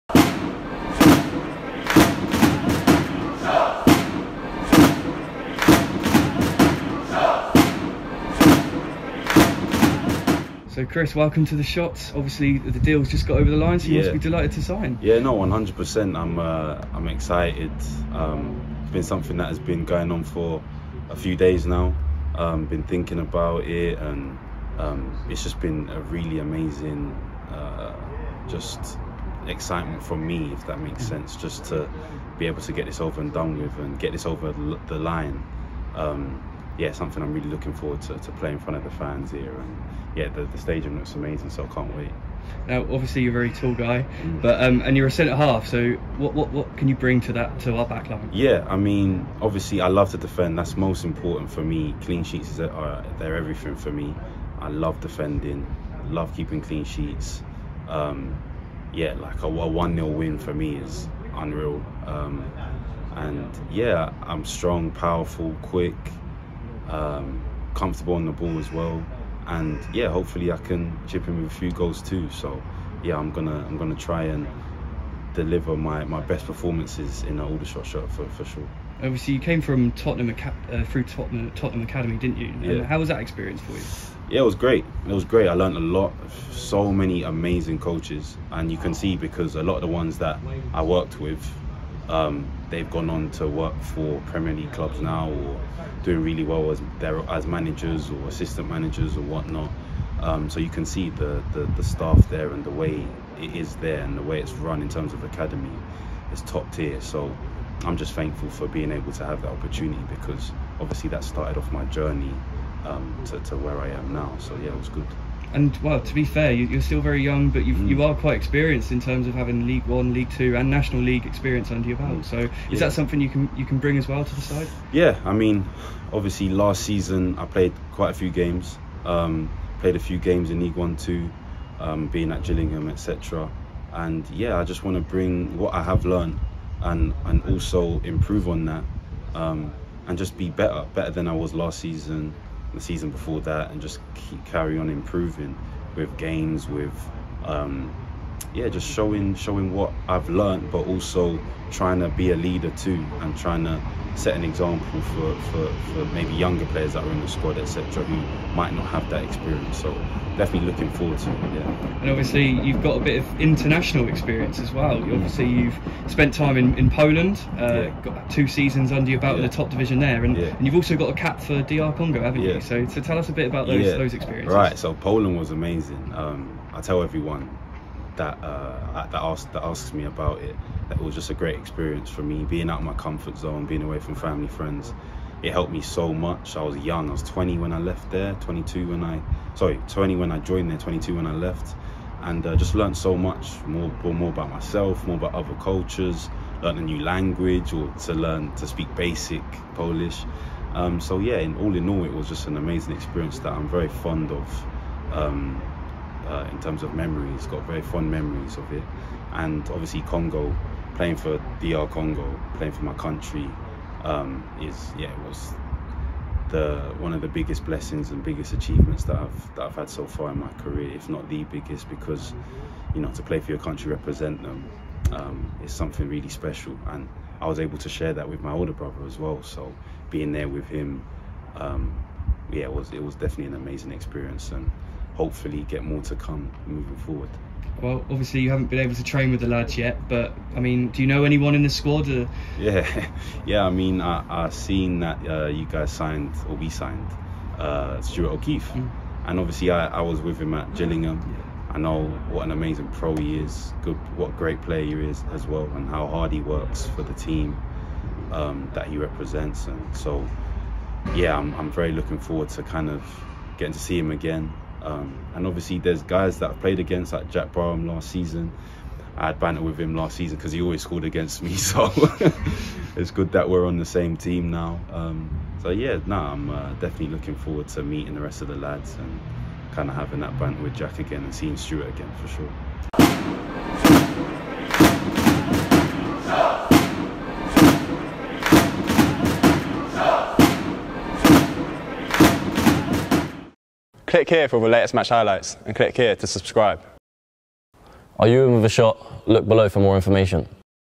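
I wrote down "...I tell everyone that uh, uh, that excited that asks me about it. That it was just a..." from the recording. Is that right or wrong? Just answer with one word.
wrong.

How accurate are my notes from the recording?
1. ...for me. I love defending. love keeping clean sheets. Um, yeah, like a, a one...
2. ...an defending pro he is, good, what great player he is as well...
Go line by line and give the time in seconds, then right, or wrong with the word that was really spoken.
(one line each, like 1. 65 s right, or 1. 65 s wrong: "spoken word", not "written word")
1. 53 s right
2. 252 s wrong: "amazing", not "defending".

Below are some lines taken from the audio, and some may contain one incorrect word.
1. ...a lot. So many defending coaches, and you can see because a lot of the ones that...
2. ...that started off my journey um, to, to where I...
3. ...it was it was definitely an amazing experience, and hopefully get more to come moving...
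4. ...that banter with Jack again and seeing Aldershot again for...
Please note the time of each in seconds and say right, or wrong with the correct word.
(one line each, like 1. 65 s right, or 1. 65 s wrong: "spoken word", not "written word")
1. 85 s wrong: "amazing", not "defending"
2. 111 s right
3. 232 s right
4. 280 s wrong: "Stuart", not "Aldershot".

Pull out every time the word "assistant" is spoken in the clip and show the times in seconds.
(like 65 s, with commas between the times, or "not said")
98 s.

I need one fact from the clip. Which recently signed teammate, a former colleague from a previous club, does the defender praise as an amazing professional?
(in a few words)
Stuart O'Keeffe.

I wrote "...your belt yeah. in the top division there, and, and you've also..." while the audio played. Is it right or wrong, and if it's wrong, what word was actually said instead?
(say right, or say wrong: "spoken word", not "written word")
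right.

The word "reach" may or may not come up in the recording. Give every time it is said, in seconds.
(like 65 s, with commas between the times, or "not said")
not said.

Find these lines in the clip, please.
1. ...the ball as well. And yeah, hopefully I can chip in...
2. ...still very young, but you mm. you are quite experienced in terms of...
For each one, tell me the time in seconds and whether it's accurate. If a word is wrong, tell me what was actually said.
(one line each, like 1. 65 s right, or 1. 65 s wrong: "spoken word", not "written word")
1. 68 s right
2. 116 s right.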